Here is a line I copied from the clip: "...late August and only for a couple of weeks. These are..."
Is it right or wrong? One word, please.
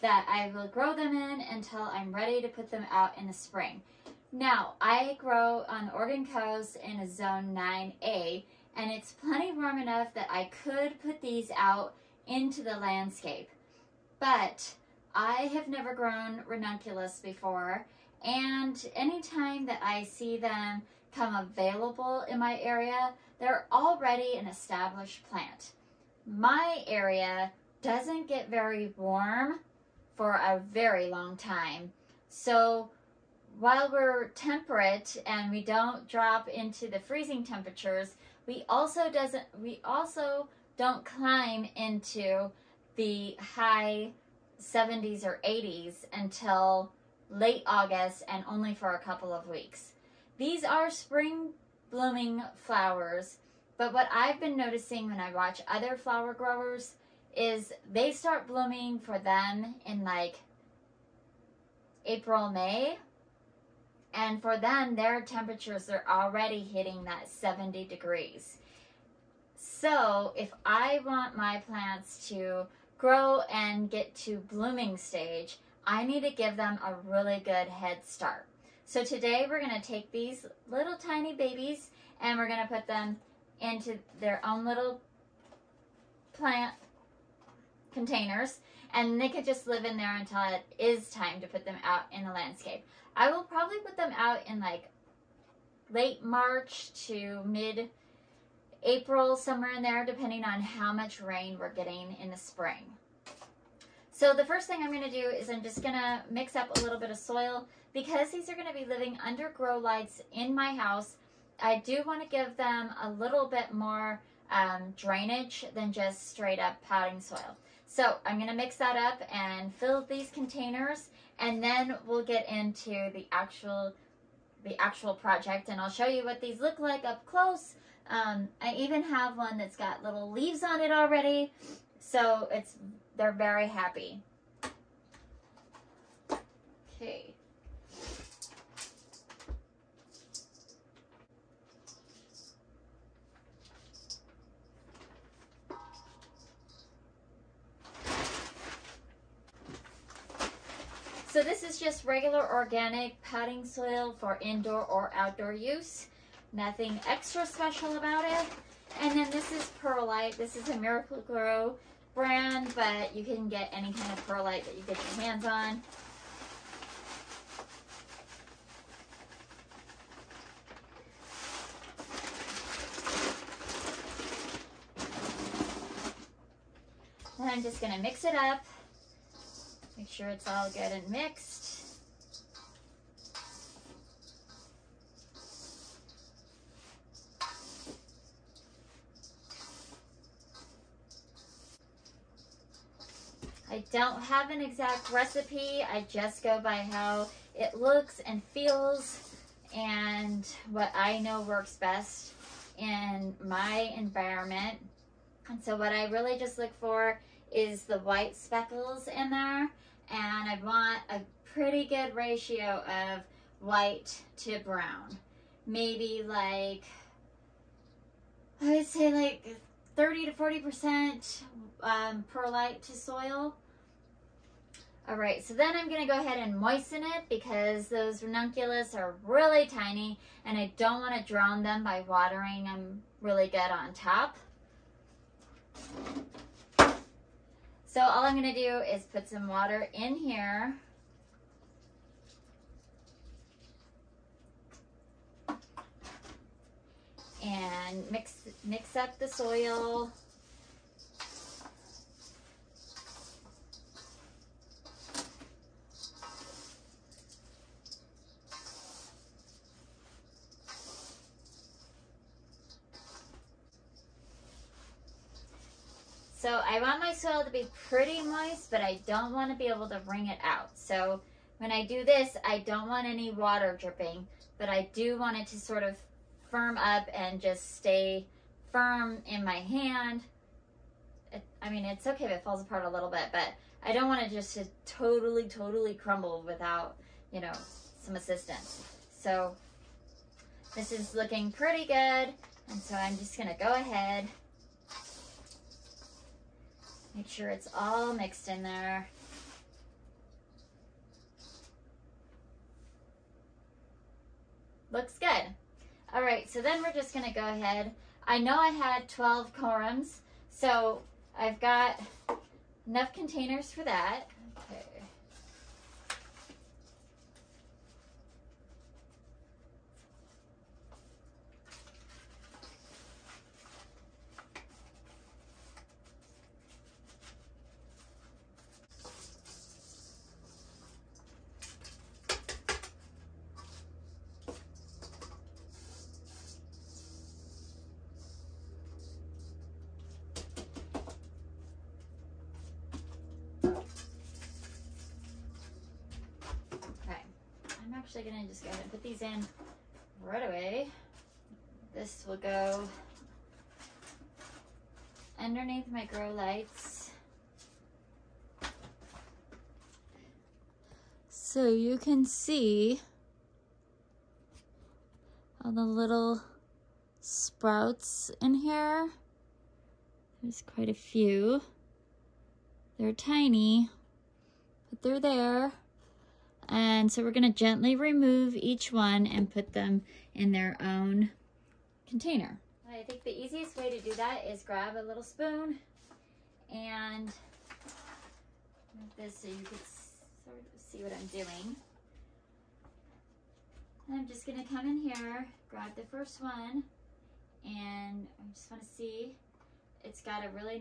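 right.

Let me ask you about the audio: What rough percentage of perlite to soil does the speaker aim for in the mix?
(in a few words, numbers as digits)
30 to 40%.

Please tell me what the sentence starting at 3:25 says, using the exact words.
And so what I really just look for is the white speckles in there.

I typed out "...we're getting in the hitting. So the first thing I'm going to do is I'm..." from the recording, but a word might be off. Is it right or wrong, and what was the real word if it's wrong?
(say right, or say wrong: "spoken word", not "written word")
wrong: "spring", not "hitting".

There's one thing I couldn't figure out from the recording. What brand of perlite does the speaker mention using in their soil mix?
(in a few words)
Miracle-Gro.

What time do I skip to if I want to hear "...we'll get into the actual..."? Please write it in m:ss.
2:02.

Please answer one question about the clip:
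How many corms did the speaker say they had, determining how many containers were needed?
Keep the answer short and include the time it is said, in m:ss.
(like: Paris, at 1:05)
12, at 5:09.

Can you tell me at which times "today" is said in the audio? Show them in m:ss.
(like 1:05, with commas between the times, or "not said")
1:19.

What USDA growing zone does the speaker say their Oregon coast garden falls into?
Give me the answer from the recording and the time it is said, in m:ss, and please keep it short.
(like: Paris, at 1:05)
9A, at 0:07.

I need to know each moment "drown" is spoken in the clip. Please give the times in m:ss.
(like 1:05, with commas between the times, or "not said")
3:51.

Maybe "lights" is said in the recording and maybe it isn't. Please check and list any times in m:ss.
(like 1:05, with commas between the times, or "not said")
1:49, 5:56.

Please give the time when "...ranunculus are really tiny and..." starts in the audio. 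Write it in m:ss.
3:48.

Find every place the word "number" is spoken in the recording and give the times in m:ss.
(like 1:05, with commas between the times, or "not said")
not said.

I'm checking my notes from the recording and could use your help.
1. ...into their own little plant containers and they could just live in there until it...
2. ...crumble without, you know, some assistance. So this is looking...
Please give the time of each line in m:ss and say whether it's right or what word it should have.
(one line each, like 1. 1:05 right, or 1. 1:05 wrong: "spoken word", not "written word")
1. 1:23 right
2. 4:45 right.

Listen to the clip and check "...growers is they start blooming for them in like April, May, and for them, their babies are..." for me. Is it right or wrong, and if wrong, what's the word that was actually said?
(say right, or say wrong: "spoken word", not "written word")
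wrong: "temperatures", not "babies".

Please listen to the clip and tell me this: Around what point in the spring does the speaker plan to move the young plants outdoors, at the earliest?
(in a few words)
late March.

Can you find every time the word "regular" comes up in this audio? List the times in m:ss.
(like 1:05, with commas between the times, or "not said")
2:32.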